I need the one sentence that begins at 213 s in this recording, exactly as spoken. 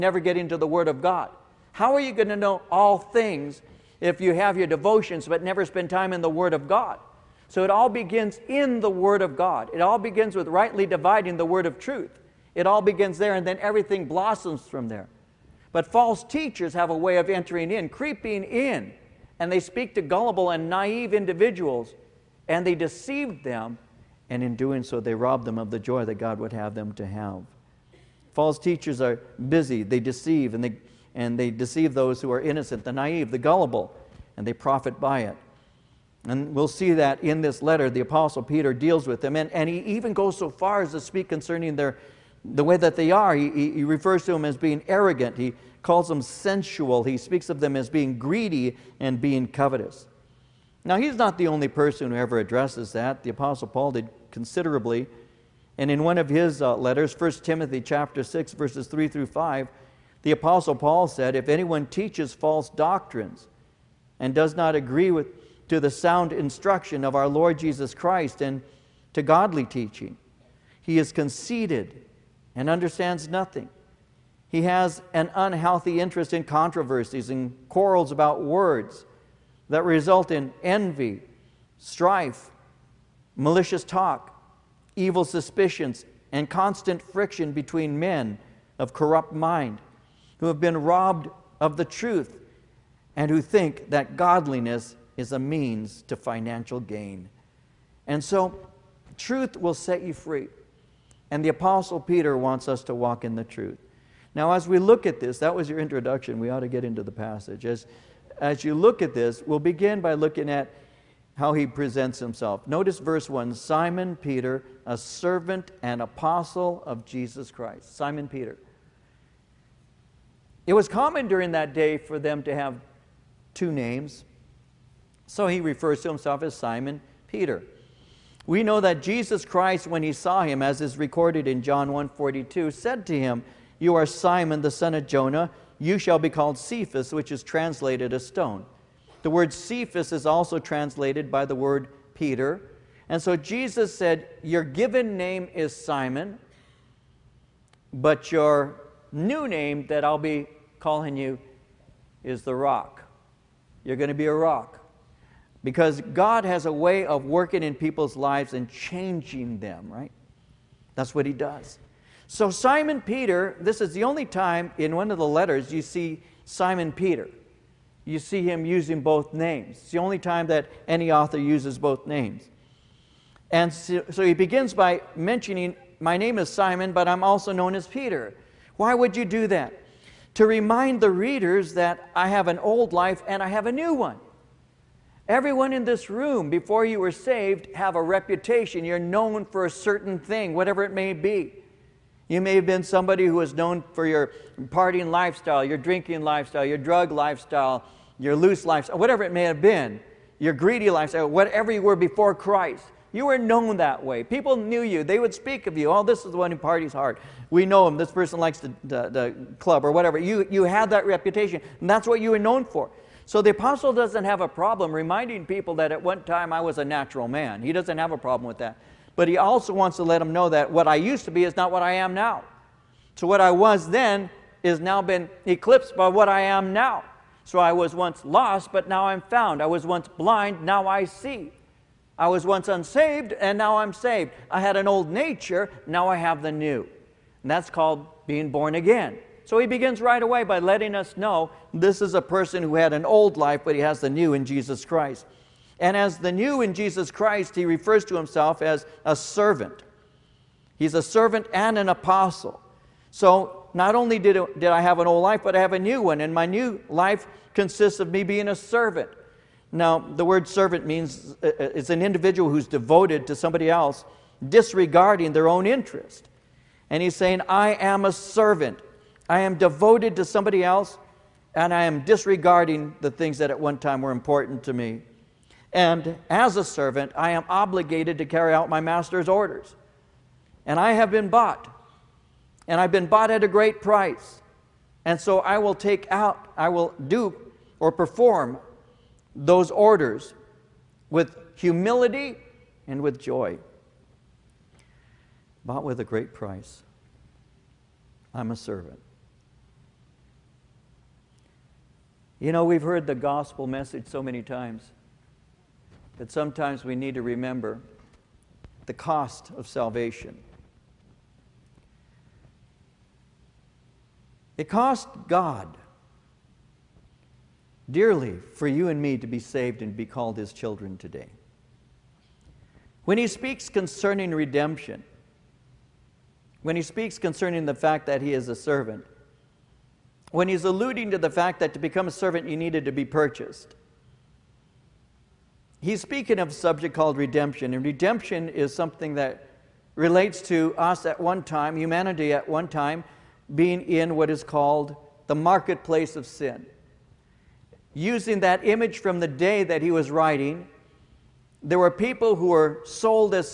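So the apostle doesn't have a problem reminding people that at one time I was a natural man.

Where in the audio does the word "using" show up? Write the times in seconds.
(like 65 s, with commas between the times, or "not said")
168 s, 347 s.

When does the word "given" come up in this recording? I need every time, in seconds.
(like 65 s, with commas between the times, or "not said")
144 s.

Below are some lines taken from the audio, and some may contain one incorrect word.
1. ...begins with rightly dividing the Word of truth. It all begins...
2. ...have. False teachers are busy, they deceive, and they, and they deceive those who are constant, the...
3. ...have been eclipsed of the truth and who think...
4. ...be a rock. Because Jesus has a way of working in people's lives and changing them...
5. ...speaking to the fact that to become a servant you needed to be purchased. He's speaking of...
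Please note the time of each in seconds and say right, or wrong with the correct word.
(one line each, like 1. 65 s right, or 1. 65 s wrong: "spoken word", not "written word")
1. 9 s right
2. 27 s wrong: "innocent", not "constant"
3. 90 s wrong: "robbed", not "eclipsed"
4. 154 s wrong: "God", not "Jesus"
5. 330 s wrong: "alluding", not "speaking".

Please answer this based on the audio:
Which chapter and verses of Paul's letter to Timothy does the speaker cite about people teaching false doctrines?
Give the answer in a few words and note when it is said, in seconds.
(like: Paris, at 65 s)
1 Timothy 6:3-5, at 57 s.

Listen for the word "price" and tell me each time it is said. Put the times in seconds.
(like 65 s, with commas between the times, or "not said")
283 s, 296 s.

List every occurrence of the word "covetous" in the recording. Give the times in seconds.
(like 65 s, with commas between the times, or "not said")
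49 s.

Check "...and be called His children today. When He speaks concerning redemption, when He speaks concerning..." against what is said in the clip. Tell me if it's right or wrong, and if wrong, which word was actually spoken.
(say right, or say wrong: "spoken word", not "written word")
right.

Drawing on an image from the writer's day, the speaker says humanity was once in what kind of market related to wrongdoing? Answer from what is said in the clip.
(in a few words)
The marketplace of sin.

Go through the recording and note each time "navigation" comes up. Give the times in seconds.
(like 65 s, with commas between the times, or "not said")
not said.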